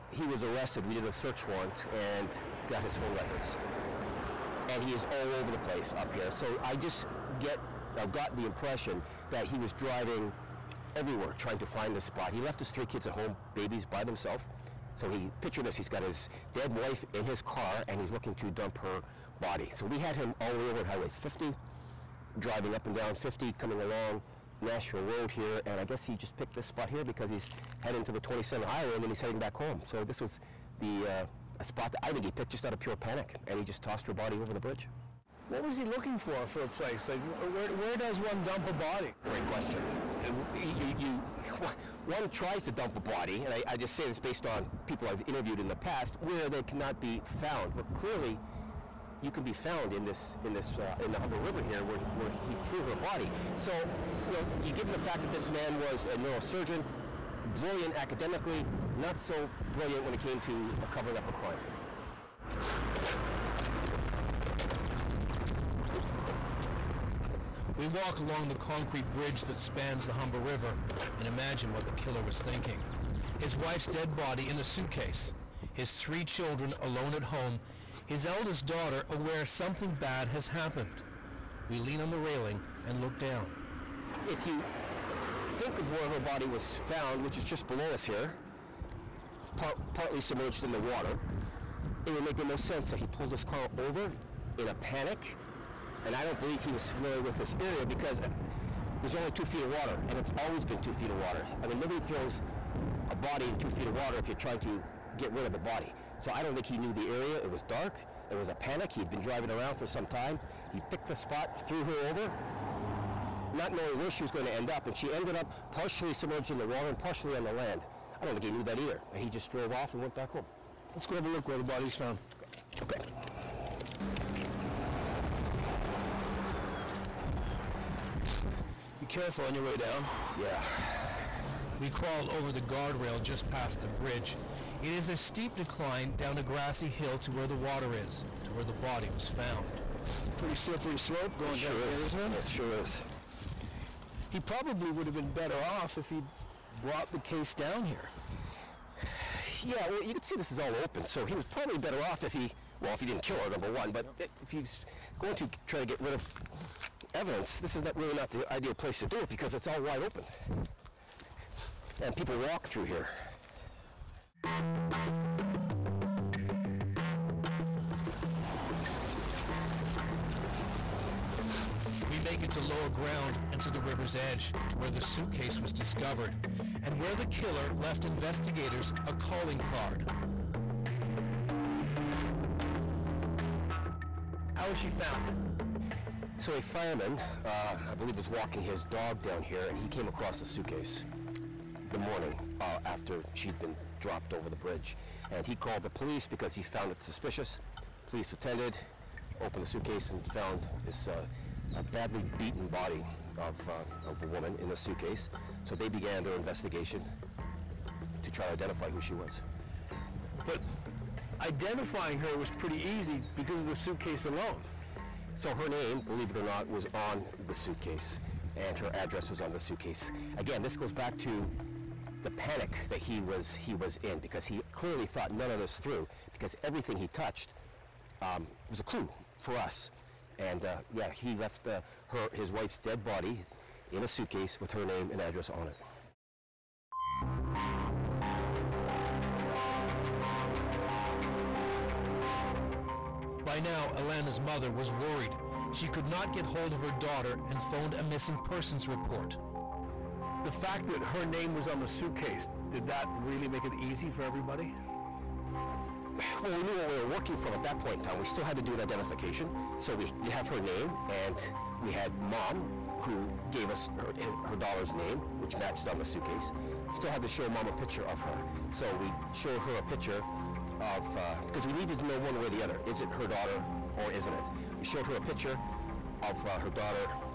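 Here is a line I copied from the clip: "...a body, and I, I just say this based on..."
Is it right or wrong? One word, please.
right.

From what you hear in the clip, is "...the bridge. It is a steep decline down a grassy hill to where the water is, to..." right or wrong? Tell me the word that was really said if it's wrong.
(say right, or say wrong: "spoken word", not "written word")
right.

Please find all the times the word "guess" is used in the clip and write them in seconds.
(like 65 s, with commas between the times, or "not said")
25 s.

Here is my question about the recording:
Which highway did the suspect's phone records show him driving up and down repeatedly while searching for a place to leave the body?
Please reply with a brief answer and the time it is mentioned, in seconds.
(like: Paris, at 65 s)
Highway 50, at 20 s.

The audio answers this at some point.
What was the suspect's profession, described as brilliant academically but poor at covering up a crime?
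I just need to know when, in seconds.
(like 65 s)
56 s.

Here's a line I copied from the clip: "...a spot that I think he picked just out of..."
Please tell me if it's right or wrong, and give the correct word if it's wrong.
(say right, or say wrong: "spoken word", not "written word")
right.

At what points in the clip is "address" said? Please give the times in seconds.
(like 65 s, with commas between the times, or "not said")
218 s, 235 s.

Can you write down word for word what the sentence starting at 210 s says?
But identifying her was pretty easy because of the suitcase alone.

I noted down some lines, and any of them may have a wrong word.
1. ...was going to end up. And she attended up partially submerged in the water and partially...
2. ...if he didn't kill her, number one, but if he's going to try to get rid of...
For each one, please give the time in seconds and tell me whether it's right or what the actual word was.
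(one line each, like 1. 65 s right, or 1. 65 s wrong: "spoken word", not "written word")
1. 114 s wrong: "ended", not "attended"
2. 152 s right.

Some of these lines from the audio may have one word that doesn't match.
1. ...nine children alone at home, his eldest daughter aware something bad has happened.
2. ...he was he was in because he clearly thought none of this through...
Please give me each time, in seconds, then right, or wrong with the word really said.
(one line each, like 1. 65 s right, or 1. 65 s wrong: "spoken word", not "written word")
1. 75 s wrong: "three", not "nine"
2. 222 s right.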